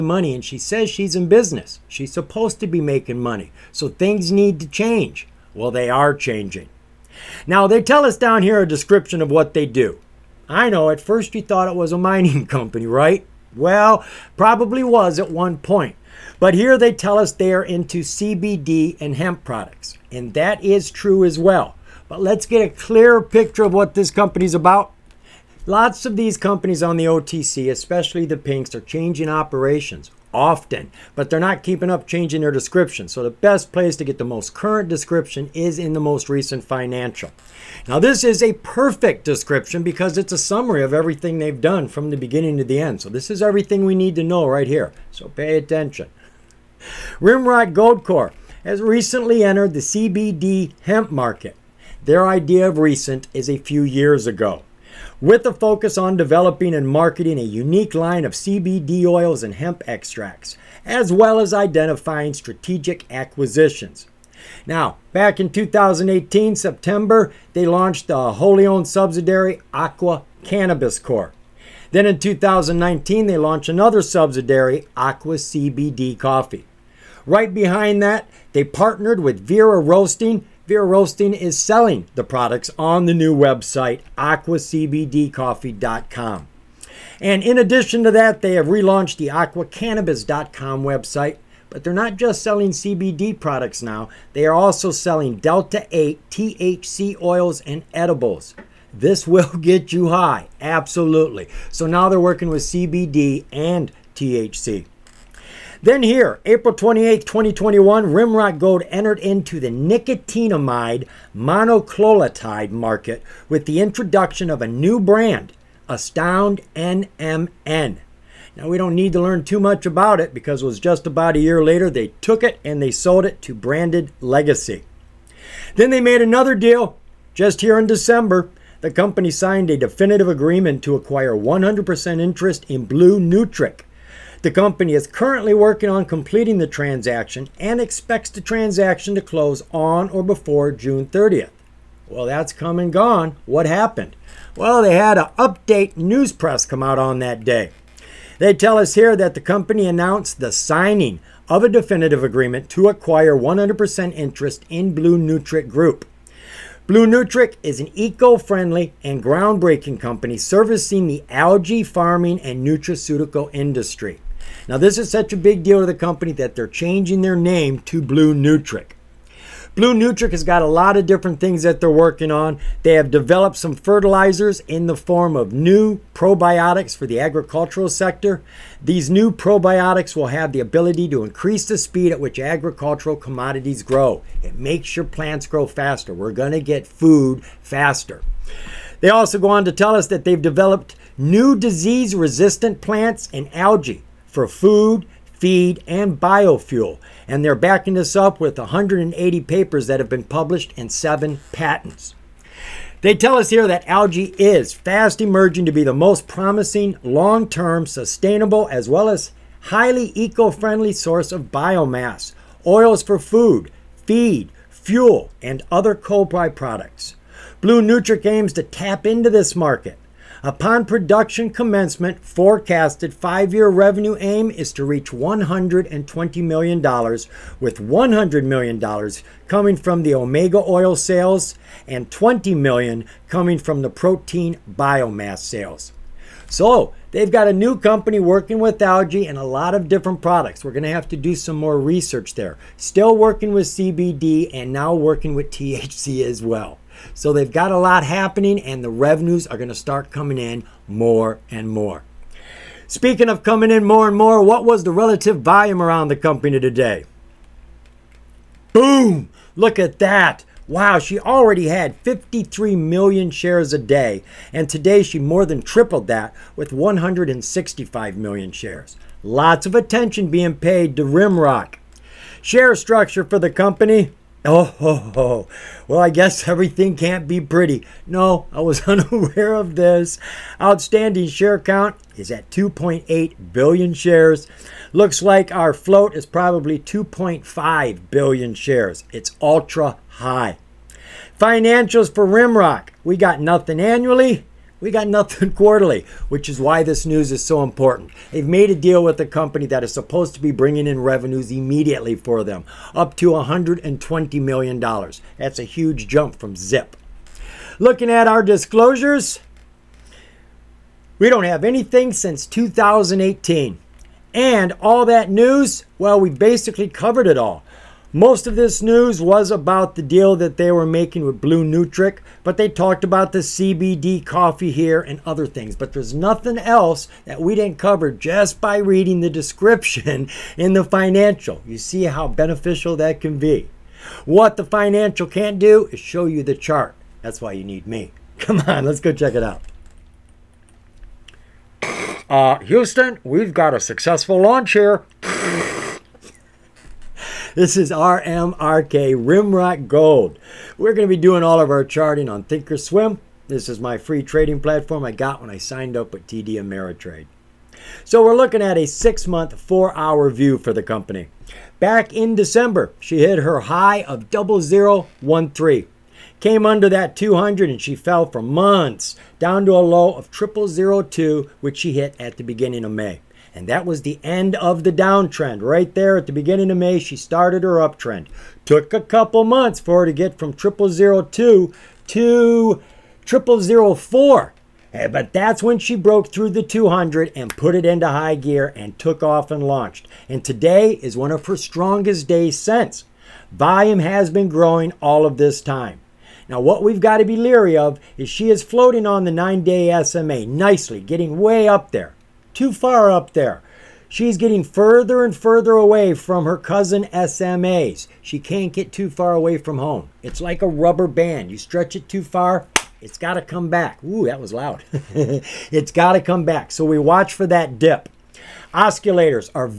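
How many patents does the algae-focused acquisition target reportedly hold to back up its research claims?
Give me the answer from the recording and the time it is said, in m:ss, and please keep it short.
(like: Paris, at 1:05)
7, at 3:20.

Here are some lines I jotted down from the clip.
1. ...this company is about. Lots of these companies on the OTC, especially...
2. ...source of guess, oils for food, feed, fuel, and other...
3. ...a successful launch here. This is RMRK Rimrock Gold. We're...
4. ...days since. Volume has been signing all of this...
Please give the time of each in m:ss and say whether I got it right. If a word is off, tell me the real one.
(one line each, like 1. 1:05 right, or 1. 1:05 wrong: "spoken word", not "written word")
1. 0:23 right
2. 3:30 wrong: "biomass", not "guess"
3. 5:43 right
4. 6:32 wrong: "growing", not "signing".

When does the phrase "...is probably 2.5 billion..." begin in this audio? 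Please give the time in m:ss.
4:46.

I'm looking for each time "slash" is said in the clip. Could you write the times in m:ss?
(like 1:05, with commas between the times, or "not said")
not said.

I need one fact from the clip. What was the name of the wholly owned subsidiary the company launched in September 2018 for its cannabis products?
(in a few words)
Aqua Cannabis Corp.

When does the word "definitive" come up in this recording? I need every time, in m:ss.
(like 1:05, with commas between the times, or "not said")
2:09, 2:31.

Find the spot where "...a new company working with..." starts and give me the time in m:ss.
3:57.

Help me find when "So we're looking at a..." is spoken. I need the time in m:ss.
5:58.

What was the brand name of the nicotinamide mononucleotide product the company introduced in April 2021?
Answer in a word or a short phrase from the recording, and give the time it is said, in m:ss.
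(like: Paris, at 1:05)
Astound NMN, at 1:55.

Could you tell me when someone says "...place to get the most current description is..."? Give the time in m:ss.
0:33.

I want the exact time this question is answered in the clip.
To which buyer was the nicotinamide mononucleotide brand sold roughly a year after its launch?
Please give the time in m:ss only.
2:03.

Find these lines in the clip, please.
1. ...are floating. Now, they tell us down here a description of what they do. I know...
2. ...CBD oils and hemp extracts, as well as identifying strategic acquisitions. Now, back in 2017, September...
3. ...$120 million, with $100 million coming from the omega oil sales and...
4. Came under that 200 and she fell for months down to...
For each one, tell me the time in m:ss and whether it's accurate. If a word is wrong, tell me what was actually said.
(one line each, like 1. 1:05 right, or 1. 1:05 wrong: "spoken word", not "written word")
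1. 0:05 wrong: "changing", not "floating"
2. 0:58 wrong: "2018", not "2017"
3. 3:45 right
4. 6:06 right.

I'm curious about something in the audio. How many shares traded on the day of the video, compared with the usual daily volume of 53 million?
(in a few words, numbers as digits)
165 million.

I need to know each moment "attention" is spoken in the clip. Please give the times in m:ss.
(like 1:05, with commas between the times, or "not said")
0:45, 4:29.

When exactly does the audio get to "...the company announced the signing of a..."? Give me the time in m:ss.
2:29.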